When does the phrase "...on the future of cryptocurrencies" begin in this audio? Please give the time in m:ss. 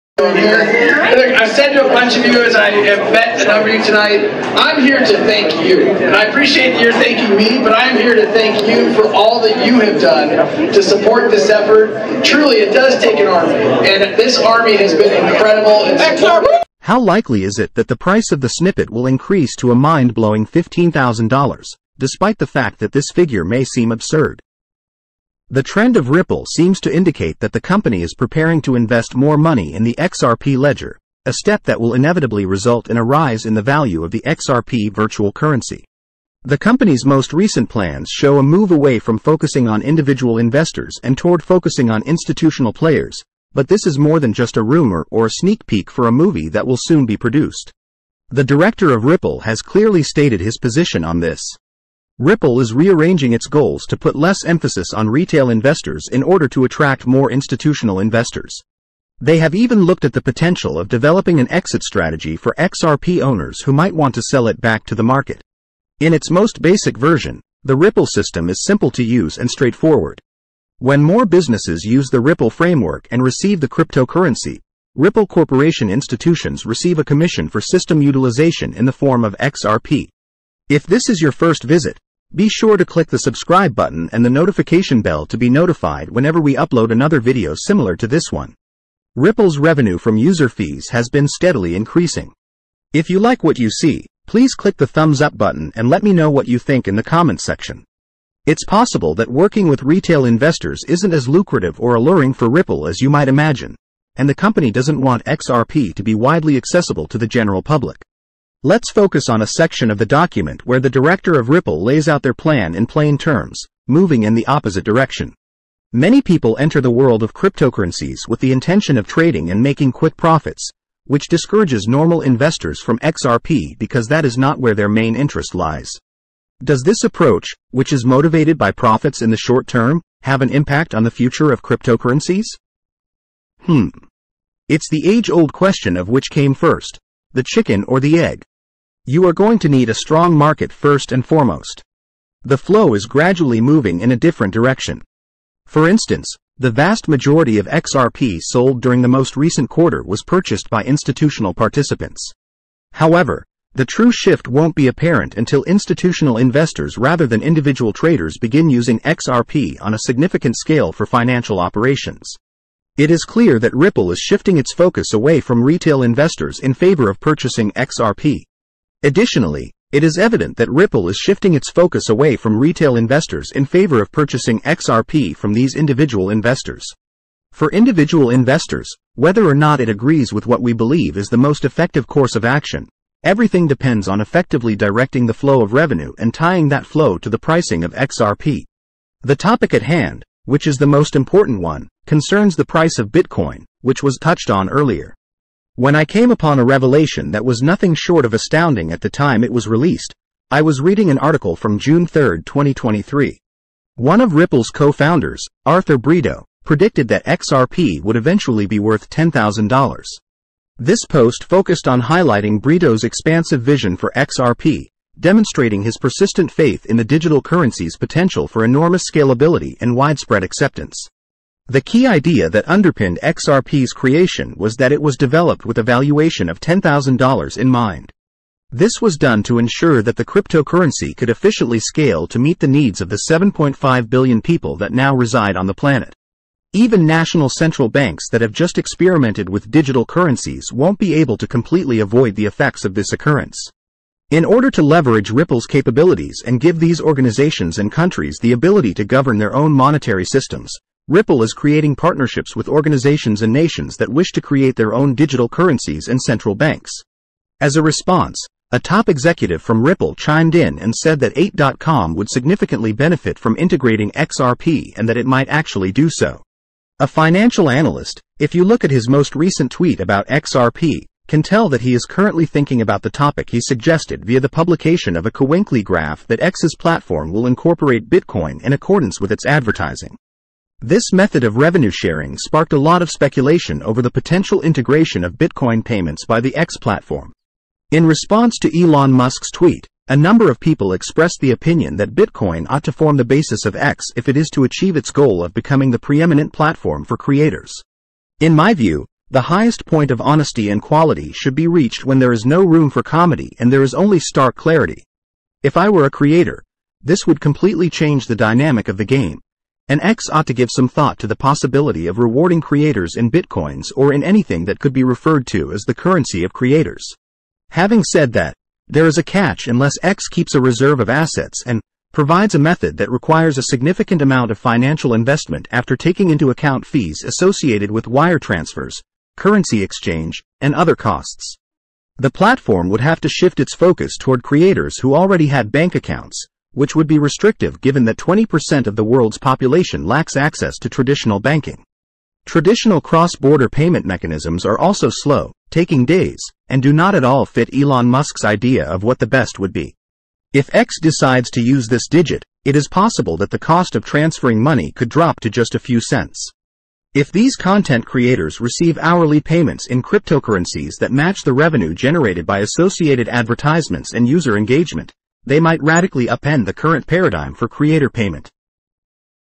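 2:10.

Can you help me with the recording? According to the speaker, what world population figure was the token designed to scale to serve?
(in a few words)
7.5 billion.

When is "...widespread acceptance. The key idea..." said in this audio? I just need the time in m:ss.
3:39.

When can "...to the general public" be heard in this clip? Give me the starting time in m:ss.
1:47.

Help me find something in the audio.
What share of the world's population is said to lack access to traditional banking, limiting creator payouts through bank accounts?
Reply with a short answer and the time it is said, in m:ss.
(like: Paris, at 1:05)
20%, at 5:38.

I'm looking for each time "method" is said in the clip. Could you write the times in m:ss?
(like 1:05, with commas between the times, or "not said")
4:41, 5:22.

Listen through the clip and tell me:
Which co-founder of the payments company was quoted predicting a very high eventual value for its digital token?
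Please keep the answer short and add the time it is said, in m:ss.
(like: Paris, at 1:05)
Arthur Britto, at 3:25.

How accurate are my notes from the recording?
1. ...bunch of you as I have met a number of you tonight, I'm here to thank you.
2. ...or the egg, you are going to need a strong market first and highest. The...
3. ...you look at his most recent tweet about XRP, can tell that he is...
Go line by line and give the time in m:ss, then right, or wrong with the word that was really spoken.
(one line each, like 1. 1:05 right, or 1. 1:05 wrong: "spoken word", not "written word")
1. 0:01 right
2. 2:17 wrong: "foremost", not "highest"
3. 4:28 right.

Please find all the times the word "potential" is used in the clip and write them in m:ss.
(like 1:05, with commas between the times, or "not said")
1:00, 3:37, 4:44.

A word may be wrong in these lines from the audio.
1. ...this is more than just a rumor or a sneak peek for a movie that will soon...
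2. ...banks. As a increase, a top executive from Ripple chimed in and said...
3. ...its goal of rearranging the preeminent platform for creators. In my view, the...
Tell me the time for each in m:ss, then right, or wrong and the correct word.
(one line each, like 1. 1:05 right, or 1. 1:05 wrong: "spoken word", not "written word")
1. 0:43 right
2. 4:16 wrong: "response", not "increase"
3. 4:54 wrong: "becoming", not "rearranging".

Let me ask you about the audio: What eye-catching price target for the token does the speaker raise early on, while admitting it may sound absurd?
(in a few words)
$15,000.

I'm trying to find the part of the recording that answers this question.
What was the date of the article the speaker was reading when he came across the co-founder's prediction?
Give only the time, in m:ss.
3:21.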